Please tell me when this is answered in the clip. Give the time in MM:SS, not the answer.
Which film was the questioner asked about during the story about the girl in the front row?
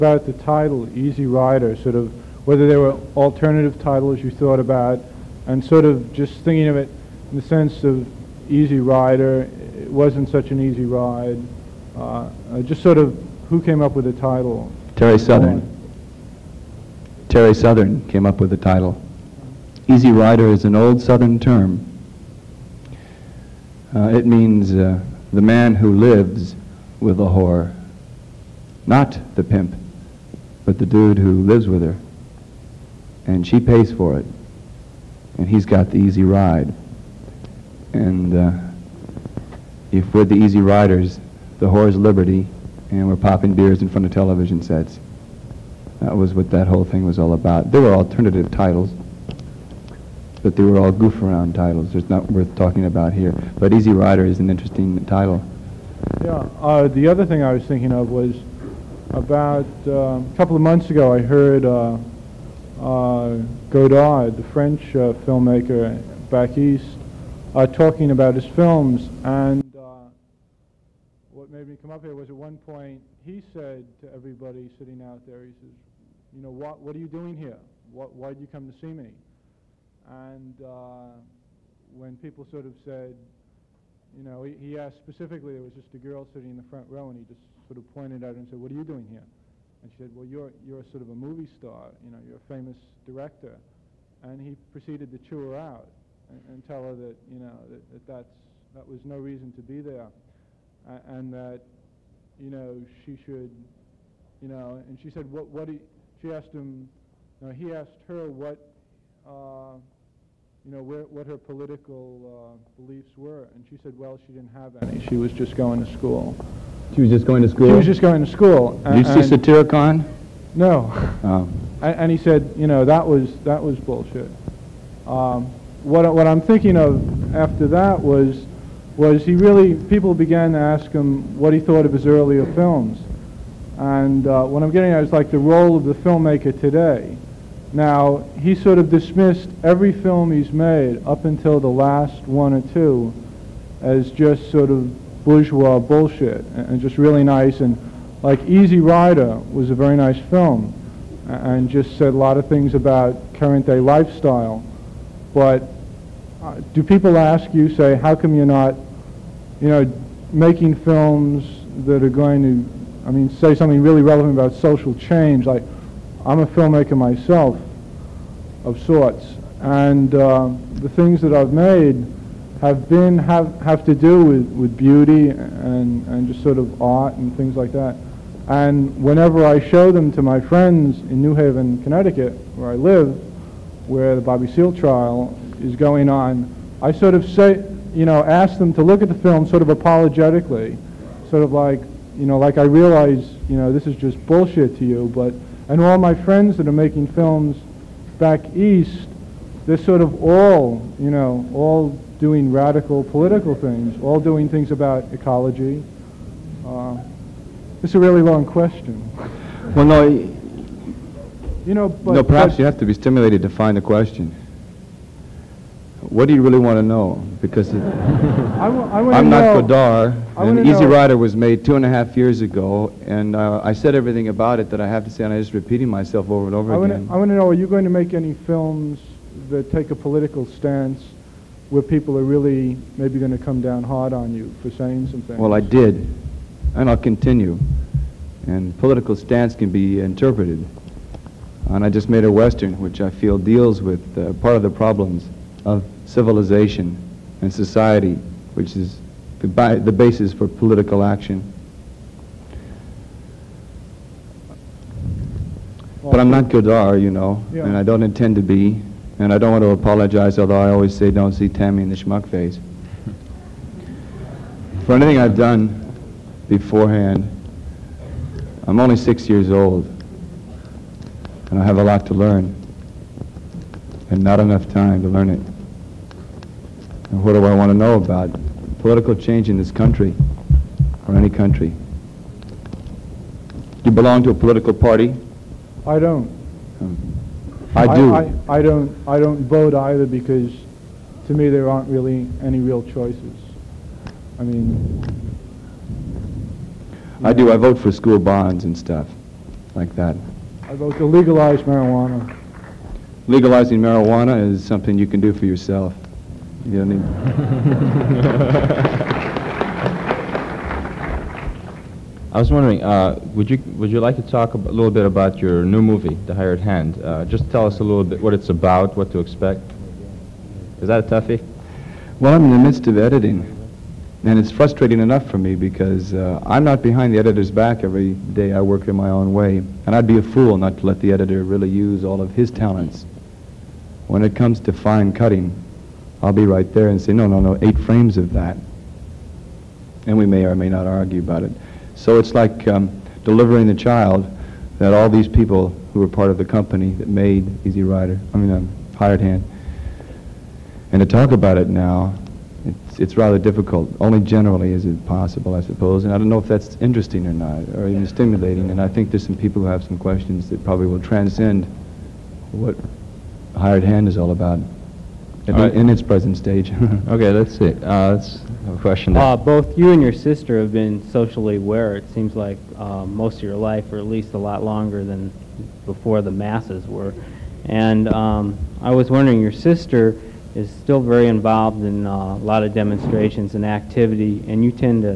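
01:59.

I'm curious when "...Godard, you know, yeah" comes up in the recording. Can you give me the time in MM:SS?
04:16.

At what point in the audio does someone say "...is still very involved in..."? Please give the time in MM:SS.
06:20.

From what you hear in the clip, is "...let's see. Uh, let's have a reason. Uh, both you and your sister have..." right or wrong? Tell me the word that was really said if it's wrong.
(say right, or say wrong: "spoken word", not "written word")
wrong: "question", not "reason".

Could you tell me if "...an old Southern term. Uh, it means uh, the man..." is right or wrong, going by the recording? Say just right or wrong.
right.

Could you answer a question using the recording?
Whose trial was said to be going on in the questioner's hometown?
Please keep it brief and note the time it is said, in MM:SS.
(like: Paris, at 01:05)
Bobby Seale, at 03:04.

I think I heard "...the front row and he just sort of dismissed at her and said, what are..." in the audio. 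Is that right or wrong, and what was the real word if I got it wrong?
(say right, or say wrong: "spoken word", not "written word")
wrong: "pointed", not "dismissed".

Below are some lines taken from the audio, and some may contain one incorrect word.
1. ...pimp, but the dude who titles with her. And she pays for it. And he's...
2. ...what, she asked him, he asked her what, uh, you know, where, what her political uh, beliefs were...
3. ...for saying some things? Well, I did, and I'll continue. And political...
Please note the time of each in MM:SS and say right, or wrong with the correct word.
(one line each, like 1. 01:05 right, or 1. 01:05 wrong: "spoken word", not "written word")
1. 00:29 wrong: "lives", not "titles"
2. 01:45 right
3. 03:54 right.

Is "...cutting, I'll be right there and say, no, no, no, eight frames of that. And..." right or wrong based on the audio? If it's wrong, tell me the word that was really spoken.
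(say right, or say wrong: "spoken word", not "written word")
right.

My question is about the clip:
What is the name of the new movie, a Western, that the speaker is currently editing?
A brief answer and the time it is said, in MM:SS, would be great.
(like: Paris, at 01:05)
The Hired Hand, at 05:16.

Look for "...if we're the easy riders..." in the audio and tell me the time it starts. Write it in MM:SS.
00:39.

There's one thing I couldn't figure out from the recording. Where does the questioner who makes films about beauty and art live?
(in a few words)
New Haven, Connecticut.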